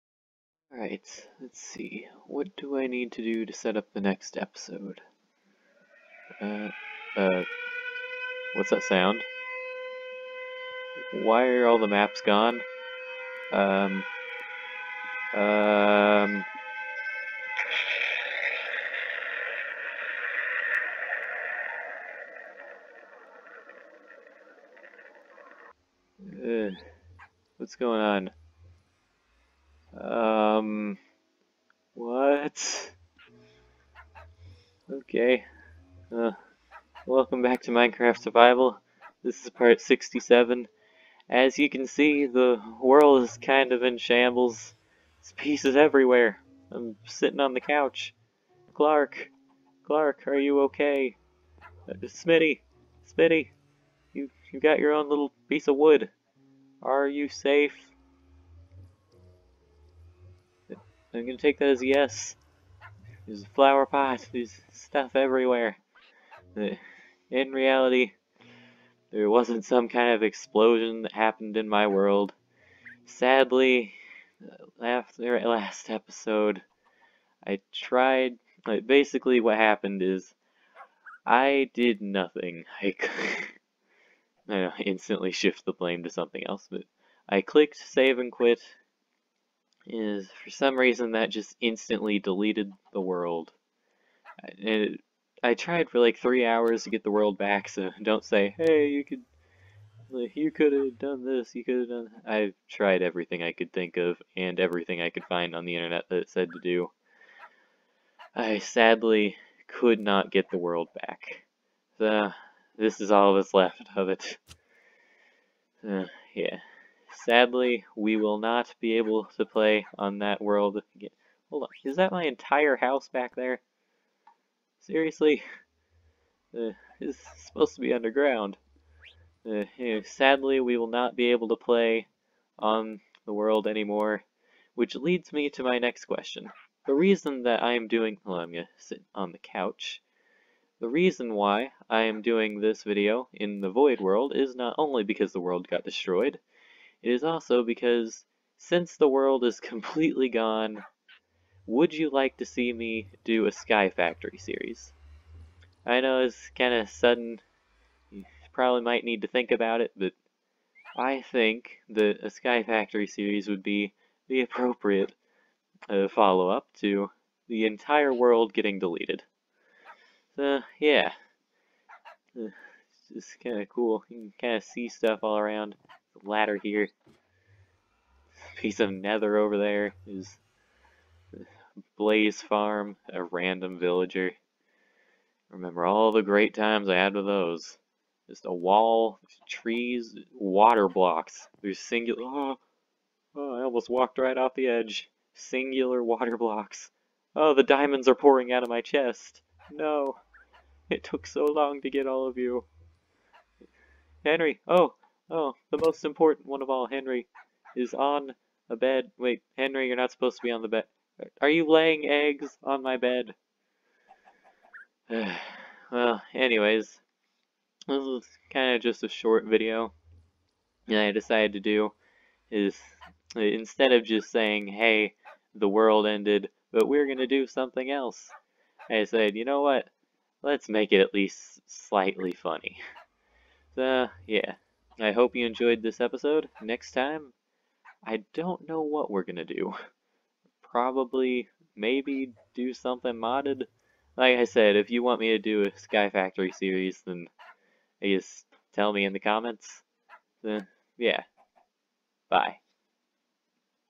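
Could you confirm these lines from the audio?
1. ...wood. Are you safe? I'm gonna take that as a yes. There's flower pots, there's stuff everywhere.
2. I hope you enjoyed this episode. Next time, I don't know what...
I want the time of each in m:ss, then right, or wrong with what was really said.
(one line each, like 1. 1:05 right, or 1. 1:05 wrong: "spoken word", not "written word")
1. 0:55 right
2. 3:54 right.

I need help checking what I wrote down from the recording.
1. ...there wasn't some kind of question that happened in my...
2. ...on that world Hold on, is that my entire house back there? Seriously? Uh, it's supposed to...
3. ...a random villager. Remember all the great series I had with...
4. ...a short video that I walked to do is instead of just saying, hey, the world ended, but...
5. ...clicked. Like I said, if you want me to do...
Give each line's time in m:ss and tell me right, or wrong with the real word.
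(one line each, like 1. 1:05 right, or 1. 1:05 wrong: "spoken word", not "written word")
1. 1:09 wrong: "explosion", not "question"
2. 1:59 right
3. 3:03 wrong: "times", not "series"
4. 3:39 wrong: "decided", not "walked"
5. 4:03 wrong: "modded", not "clicked".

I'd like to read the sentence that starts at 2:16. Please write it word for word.
The reason that I am doing...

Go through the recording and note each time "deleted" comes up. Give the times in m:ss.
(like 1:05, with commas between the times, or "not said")
1:32, 2:48.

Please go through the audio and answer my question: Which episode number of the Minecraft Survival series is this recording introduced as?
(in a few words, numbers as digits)
67.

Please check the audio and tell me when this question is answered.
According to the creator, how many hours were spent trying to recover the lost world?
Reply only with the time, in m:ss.
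1:36.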